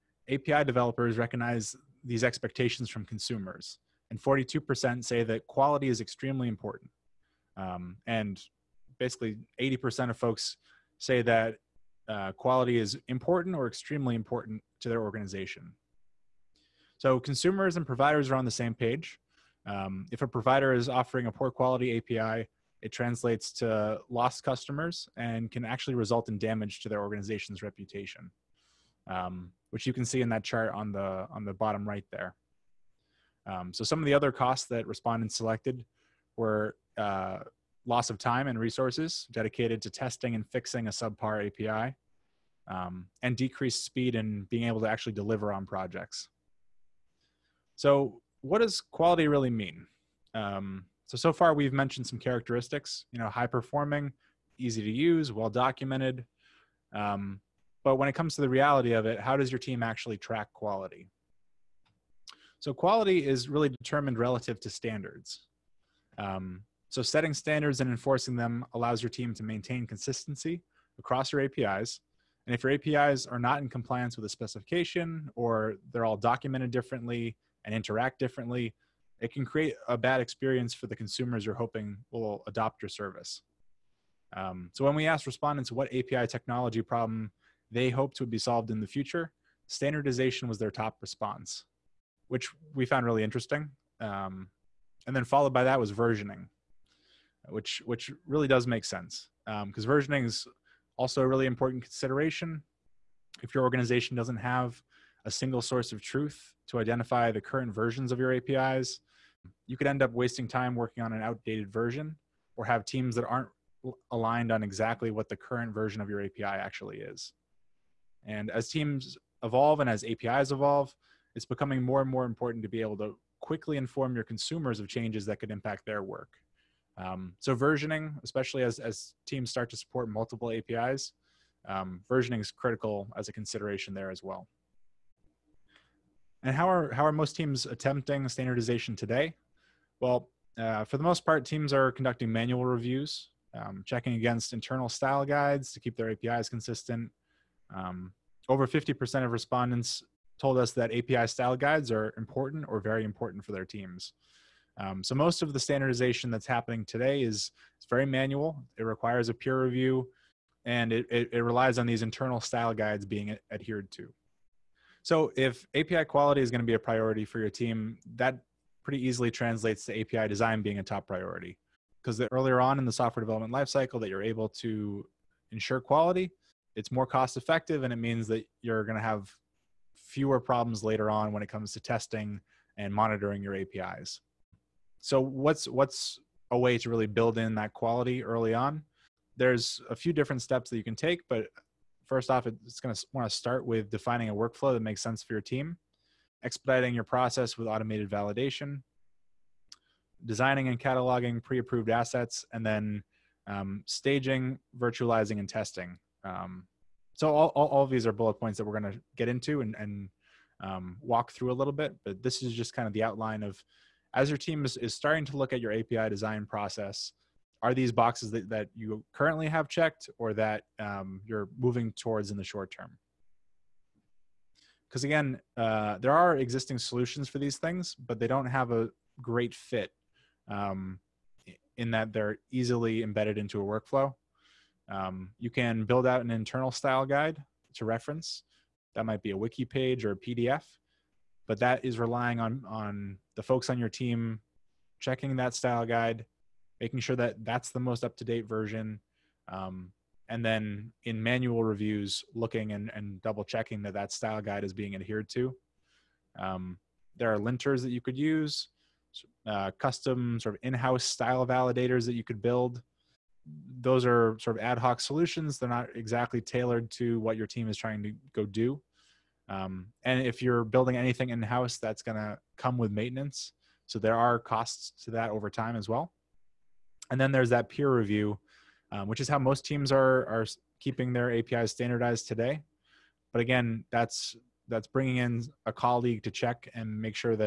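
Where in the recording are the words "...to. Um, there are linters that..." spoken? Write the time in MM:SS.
04:15.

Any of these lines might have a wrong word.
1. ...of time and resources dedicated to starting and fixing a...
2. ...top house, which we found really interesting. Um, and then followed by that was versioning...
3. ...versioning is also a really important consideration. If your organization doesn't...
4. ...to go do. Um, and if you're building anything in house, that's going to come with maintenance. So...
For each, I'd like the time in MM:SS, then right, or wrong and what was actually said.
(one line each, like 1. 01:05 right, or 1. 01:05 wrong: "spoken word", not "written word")
1. 00:38 wrong: "testing", not "starting"
2. 01:30 wrong: "response", not "house"
3. 01:39 right
4. 04:28 right.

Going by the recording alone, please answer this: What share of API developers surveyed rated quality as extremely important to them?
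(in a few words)
42%.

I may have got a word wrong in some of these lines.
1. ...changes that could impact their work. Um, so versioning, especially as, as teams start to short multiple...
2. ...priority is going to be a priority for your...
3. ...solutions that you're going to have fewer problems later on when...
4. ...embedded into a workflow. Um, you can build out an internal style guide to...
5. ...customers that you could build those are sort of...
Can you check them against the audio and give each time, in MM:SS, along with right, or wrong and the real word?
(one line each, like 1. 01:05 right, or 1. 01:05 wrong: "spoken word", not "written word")
1. 02:04 wrong: "support", not "short"
2. 02:46 wrong: "quality", not "priority"
3. 02:57 wrong: "means", not "solutions"
4. 03:53 right
5. 04:21 wrong: "validators", not "customers".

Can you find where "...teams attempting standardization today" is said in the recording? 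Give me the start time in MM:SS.
02:17.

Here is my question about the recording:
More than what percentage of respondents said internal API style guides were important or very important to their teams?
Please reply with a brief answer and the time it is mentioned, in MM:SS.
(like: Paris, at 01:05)
50%, at 02:28.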